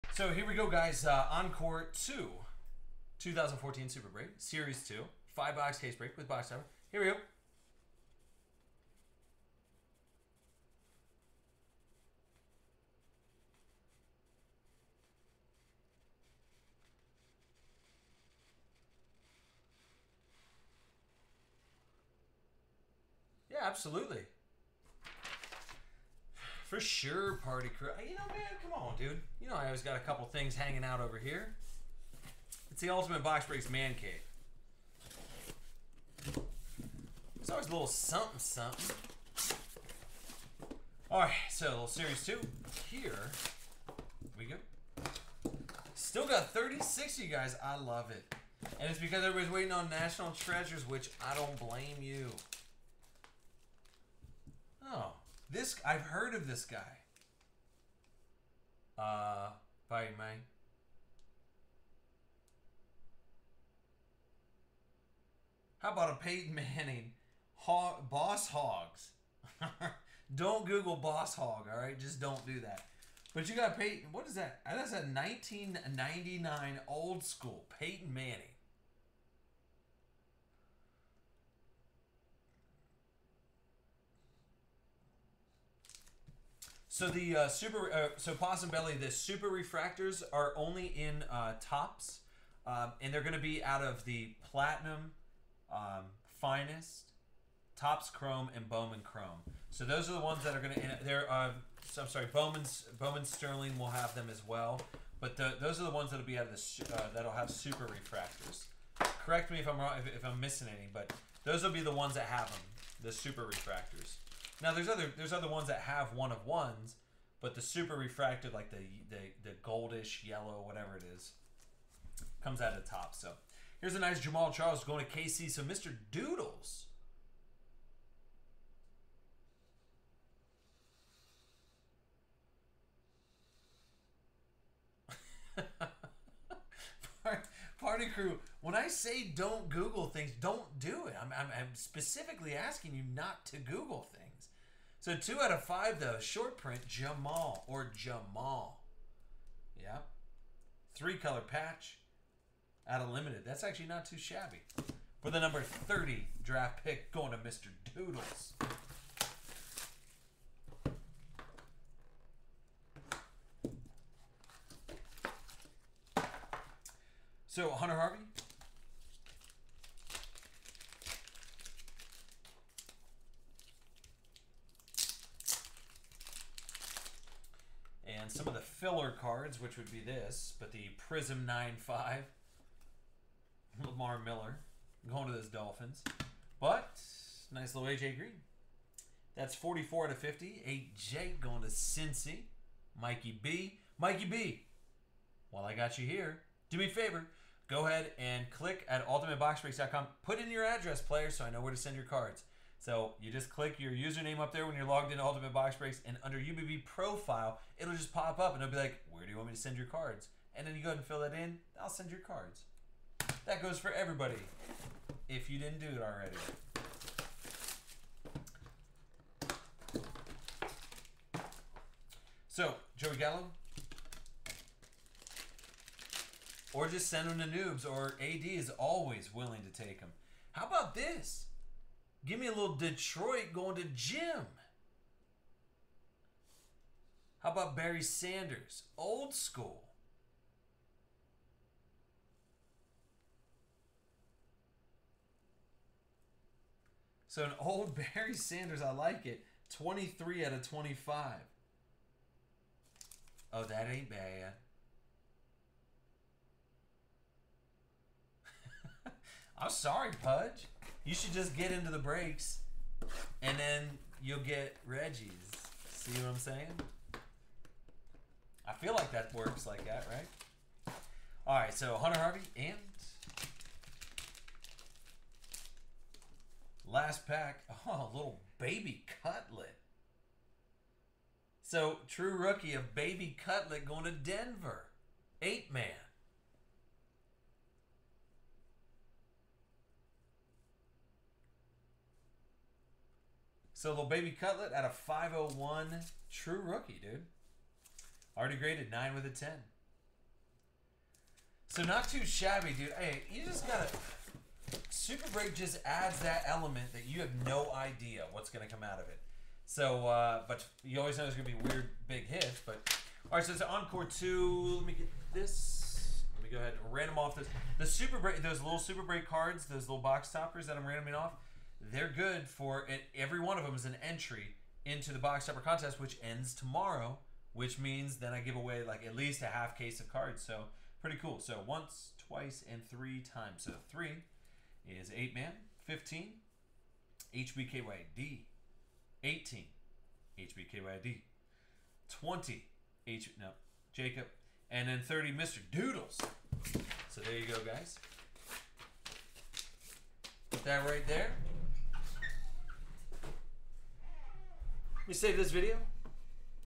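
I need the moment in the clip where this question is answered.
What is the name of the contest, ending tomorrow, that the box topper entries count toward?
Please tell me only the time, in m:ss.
5:25.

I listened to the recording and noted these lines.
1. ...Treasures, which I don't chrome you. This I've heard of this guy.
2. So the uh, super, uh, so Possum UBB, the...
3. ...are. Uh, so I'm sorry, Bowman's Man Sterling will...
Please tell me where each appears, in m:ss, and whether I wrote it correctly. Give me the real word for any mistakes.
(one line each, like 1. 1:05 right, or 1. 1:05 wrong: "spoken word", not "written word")
1. 0:50 wrong: "blame", not "chrome"
2. 1:26 wrong: "Belly", not "UBB"
3. 1:41 wrong: "Bowman", not "Man".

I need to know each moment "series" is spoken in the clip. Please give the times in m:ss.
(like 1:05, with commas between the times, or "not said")
0:04, 0:41.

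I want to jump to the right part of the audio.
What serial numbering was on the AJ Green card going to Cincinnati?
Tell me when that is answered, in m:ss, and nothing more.
3:09.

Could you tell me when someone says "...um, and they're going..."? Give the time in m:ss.
1:32.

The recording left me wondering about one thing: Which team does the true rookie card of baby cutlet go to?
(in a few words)
Denver.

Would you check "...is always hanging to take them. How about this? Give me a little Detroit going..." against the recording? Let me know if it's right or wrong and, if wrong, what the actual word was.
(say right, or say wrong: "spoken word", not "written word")
wrong: "willing", not "hanging".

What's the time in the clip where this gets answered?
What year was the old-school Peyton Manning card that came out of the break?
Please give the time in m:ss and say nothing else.
1:15.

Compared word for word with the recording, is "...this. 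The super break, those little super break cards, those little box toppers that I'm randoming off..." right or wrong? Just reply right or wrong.
right.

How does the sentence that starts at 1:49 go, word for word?
Correct me if I'm wrong, if, if I'm missing any, but those will be the ones that have them, the super refractors.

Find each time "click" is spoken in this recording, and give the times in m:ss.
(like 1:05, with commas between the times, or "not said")
3:18, 3:23.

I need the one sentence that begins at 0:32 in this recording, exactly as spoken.
It's the Ultimate Box Breaks Man Cave.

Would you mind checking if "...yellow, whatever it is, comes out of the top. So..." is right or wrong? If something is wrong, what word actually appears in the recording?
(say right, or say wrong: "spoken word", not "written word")
right.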